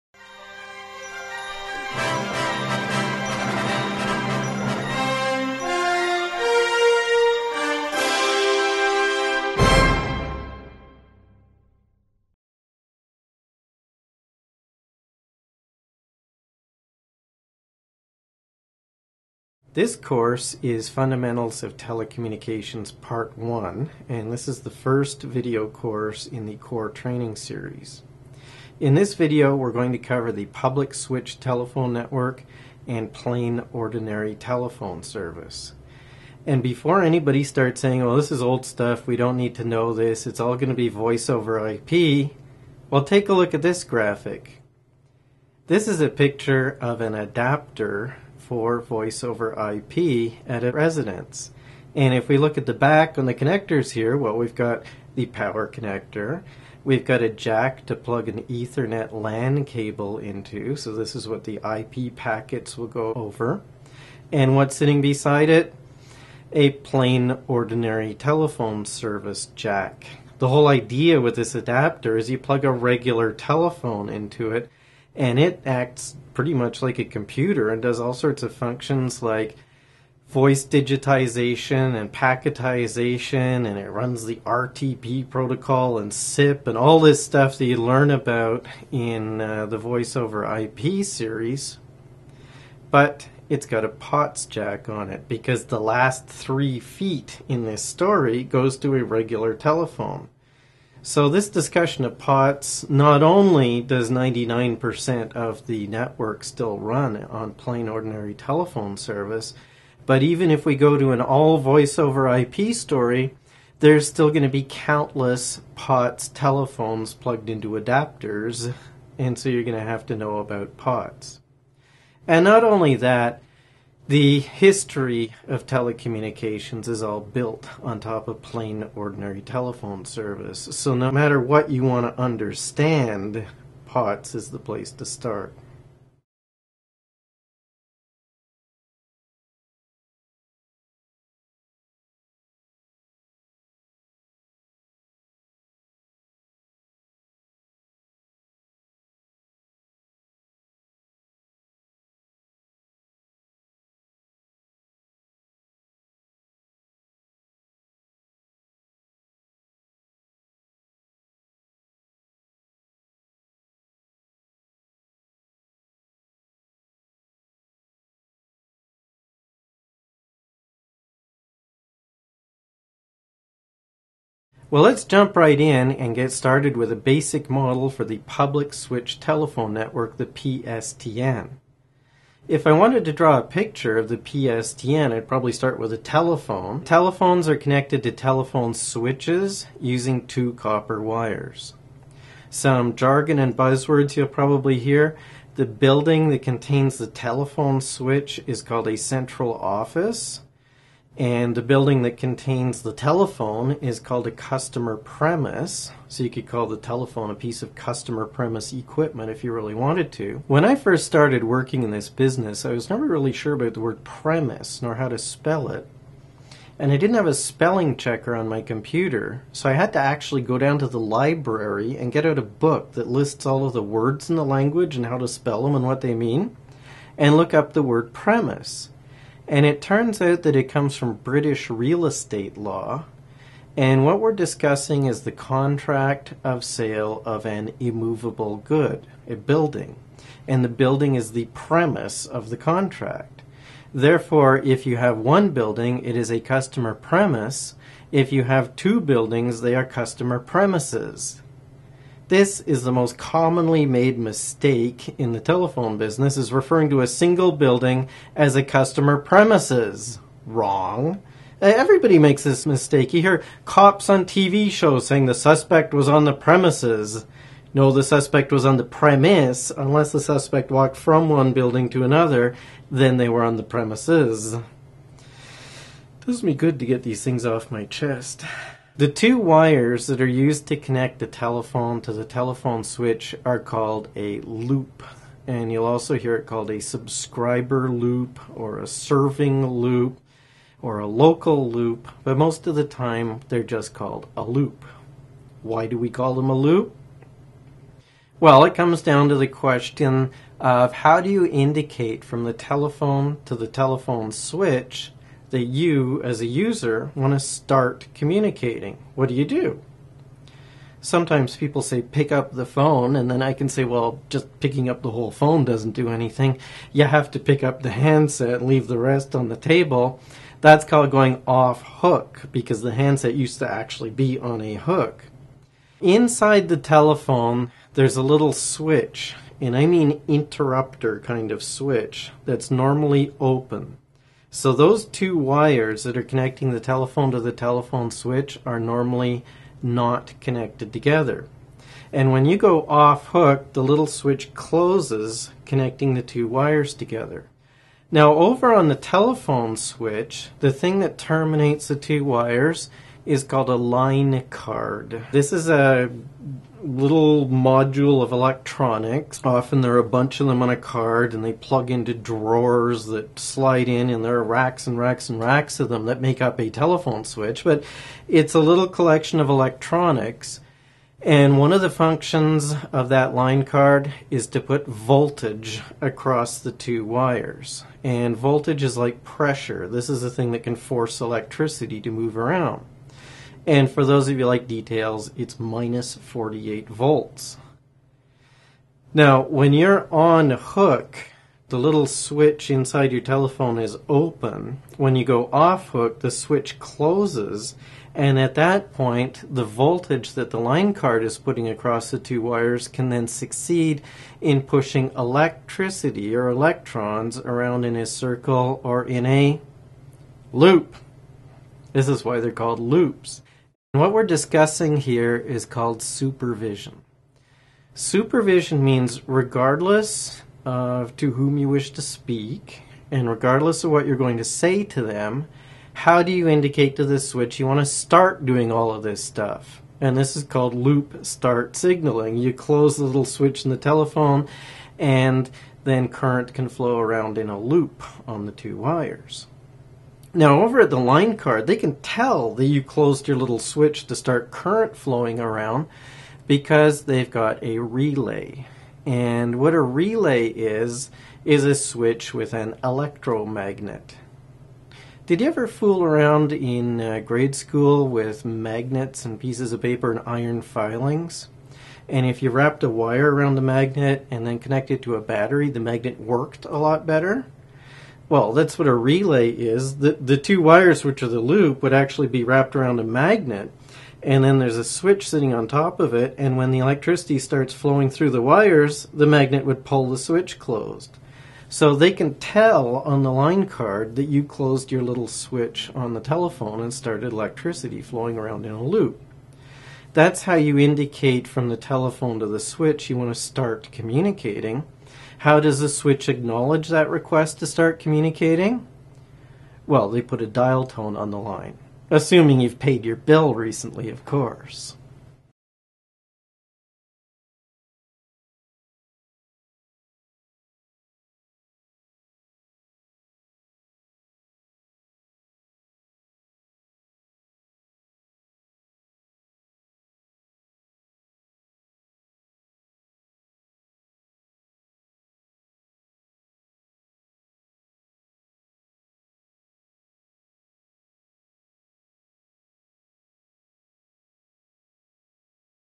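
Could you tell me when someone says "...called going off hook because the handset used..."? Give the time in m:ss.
5:20.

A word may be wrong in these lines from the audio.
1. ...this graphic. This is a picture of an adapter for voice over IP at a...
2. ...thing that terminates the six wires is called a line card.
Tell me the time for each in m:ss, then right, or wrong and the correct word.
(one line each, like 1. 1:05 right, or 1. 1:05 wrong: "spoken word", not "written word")
1. 0:43 right
2. 5:50 wrong: "two", not "six".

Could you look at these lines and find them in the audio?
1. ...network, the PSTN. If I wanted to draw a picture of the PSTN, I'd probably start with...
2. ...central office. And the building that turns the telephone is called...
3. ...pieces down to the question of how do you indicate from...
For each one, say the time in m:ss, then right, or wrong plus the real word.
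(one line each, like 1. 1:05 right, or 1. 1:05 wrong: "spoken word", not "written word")
1. 2:59 right
2. 3:18 wrong: "contains", not "turns"
3. 4:58 wrong: "comes", not "pieces".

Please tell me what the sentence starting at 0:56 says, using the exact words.
We've got a jack to plug an Ethernet LAN cable into, so this is what the IP packets will go over.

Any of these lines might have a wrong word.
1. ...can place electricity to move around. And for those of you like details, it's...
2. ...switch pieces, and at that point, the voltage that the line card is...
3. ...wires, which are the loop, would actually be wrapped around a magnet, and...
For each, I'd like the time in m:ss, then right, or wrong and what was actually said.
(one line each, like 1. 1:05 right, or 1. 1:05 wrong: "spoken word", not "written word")
1. 6:20 wrong: "force", not "place"
2. 6:36 wrong: "closes", not "pieces"
3. 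7:50 right.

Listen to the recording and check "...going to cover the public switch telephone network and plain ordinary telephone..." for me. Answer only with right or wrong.
right.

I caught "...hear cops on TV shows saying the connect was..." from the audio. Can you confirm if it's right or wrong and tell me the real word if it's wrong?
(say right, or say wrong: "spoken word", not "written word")
wrong: "suspect", not "connect".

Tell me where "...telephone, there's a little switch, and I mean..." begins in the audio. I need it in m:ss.
5:26.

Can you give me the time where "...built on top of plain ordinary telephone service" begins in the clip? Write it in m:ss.
2:07.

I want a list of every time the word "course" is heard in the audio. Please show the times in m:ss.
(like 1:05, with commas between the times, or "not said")
0:19, 0:25, 8:24.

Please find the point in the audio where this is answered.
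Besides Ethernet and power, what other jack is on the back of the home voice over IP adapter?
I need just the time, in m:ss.
1:06.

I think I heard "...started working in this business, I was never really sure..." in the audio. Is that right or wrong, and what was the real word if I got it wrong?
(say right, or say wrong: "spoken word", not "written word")
right.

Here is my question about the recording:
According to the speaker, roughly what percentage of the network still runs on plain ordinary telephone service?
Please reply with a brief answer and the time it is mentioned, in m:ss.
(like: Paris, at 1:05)
99%, at 1:44.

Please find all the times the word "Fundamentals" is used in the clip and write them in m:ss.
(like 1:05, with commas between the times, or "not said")
0:20.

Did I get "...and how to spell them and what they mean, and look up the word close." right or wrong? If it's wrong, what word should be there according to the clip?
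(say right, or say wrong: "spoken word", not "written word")
wrong: "premise", not "close".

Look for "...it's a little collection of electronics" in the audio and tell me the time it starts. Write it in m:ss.
6:08.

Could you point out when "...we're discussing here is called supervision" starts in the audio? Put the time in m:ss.
6:54.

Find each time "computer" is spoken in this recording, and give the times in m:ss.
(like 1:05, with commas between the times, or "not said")
1:17, 3:38.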